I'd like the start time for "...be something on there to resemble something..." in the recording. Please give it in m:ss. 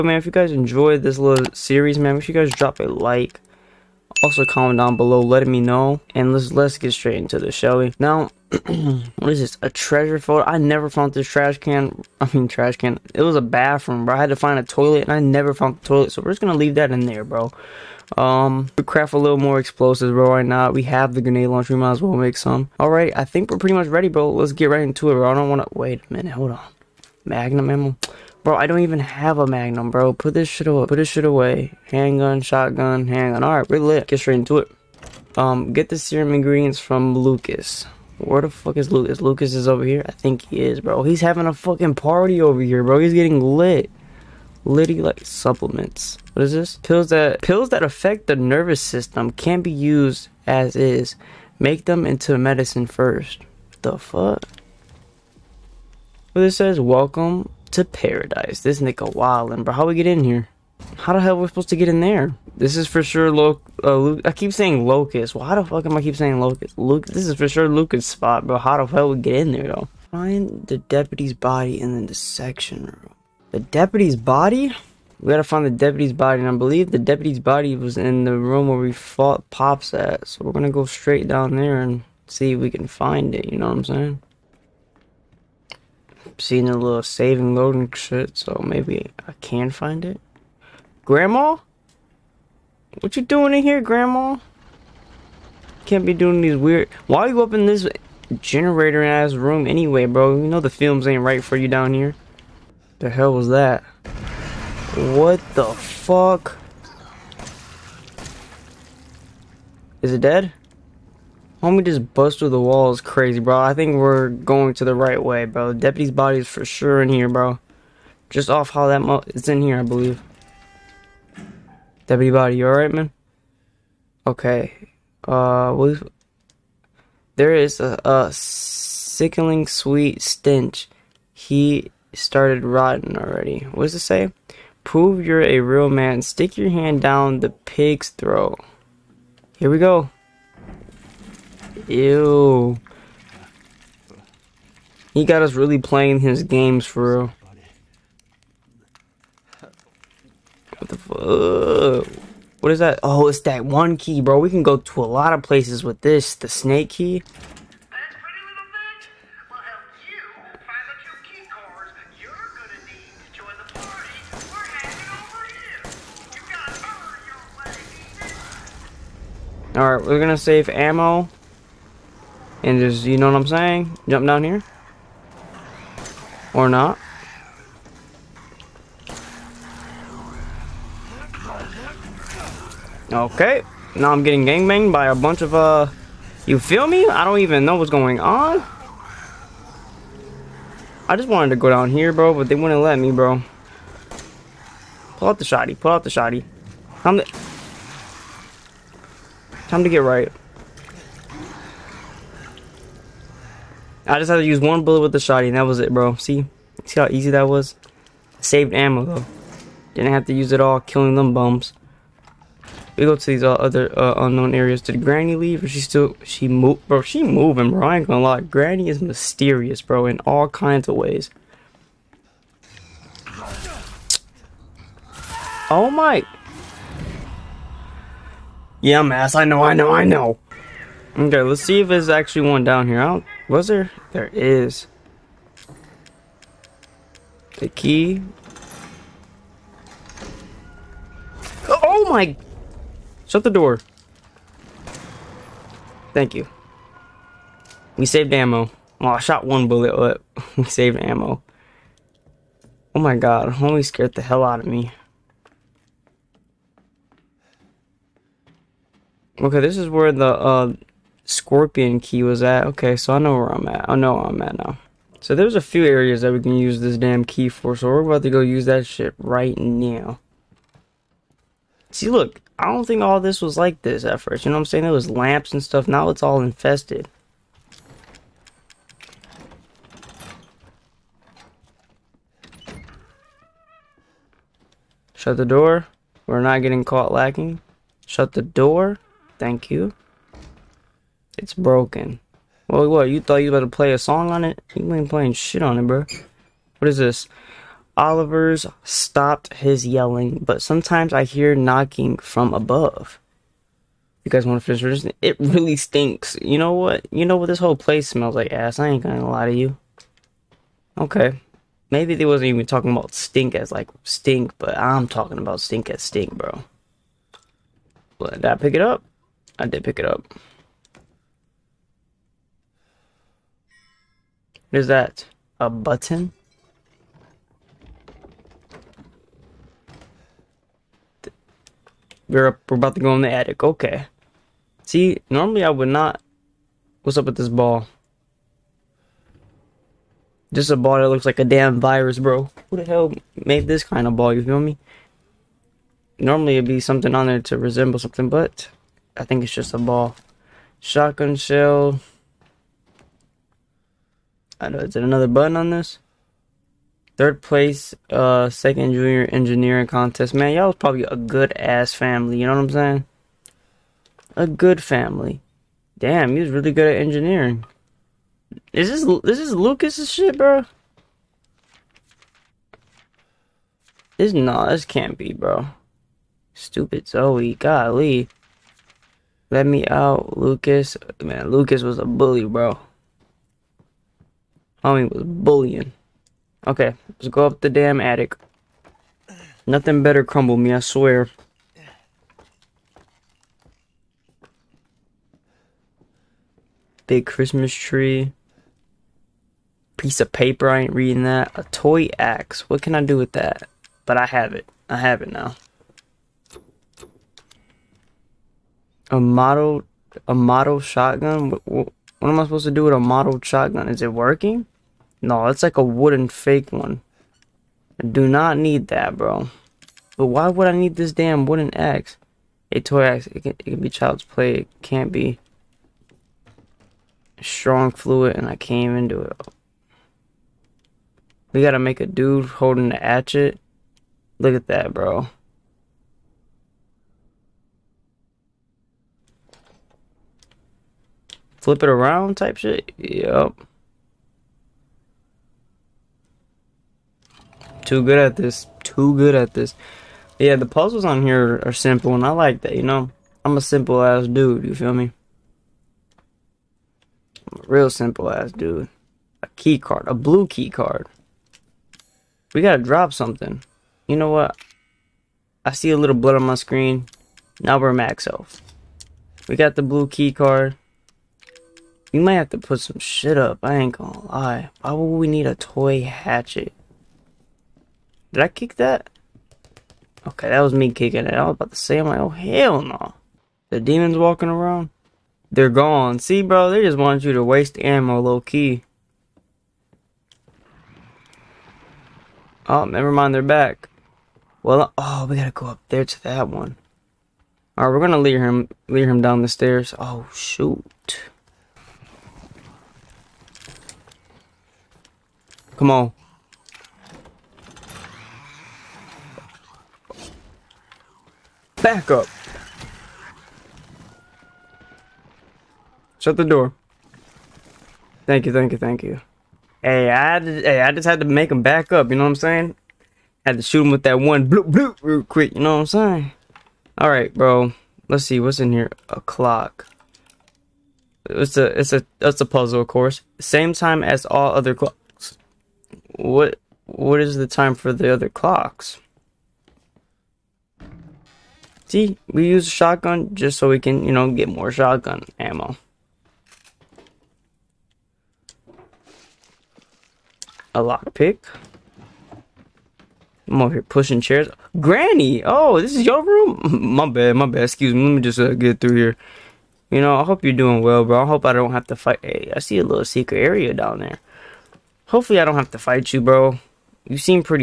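5:46.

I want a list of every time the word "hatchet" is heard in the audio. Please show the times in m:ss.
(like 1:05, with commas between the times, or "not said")
7:12, 7:56.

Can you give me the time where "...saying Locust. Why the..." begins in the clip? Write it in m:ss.
1:04.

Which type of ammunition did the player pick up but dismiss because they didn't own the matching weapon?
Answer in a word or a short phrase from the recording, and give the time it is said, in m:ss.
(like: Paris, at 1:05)
Magnum ammo, at 0:27.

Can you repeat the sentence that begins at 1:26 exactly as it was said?
seen a little save and loading shit, so maybe I can find it.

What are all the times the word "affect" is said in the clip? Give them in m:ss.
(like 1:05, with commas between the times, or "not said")
0:47.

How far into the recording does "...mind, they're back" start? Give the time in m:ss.
8:13.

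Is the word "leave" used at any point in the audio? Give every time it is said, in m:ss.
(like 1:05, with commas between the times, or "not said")
0:16, 3:35.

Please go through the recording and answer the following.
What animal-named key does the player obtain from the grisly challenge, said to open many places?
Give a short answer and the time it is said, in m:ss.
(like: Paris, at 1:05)
snake key, at 2:36.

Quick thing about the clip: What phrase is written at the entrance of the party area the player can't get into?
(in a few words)
Welcome to paradise.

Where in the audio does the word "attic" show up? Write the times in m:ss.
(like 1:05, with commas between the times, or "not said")
5:33, 6:28.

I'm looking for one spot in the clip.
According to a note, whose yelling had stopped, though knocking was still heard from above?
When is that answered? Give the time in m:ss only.
4:57.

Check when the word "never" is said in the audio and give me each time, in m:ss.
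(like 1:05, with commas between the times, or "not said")
0:10, 0:15, 8:12.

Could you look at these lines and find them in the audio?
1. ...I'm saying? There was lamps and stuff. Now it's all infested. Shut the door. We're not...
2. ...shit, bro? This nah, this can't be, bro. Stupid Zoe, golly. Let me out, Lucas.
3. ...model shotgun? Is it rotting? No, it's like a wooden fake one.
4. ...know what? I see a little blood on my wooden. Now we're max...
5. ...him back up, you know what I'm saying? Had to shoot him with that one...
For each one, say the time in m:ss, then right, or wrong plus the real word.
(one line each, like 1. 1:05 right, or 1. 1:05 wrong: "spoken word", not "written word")
1. 4:34 right
2. 6:10 right
3. 6:52 wrong: "working", not "rotting"
4. 7:44 wrong: "screen", not "wooden"
5. 8:41 right.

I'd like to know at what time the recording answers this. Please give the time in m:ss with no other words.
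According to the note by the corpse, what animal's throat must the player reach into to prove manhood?
2:17.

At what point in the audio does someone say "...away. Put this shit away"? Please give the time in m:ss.
0:30.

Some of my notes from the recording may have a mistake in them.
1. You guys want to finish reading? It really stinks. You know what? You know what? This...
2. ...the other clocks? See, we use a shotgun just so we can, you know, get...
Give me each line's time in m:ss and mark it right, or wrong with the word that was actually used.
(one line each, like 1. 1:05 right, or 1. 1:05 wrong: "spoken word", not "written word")
1. 5:04 right
2. 8:57 right.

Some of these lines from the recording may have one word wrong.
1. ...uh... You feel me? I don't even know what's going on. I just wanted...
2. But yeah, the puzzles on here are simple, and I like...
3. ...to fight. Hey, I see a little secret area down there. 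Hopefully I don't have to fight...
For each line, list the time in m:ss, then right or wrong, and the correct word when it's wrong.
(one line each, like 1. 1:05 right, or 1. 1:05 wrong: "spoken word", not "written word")
1. 3:05 right
2. 7:30 right
3. 9:21 right.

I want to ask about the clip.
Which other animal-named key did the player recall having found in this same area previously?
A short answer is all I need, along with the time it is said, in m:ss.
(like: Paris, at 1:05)
Scorpion key, at 4:21.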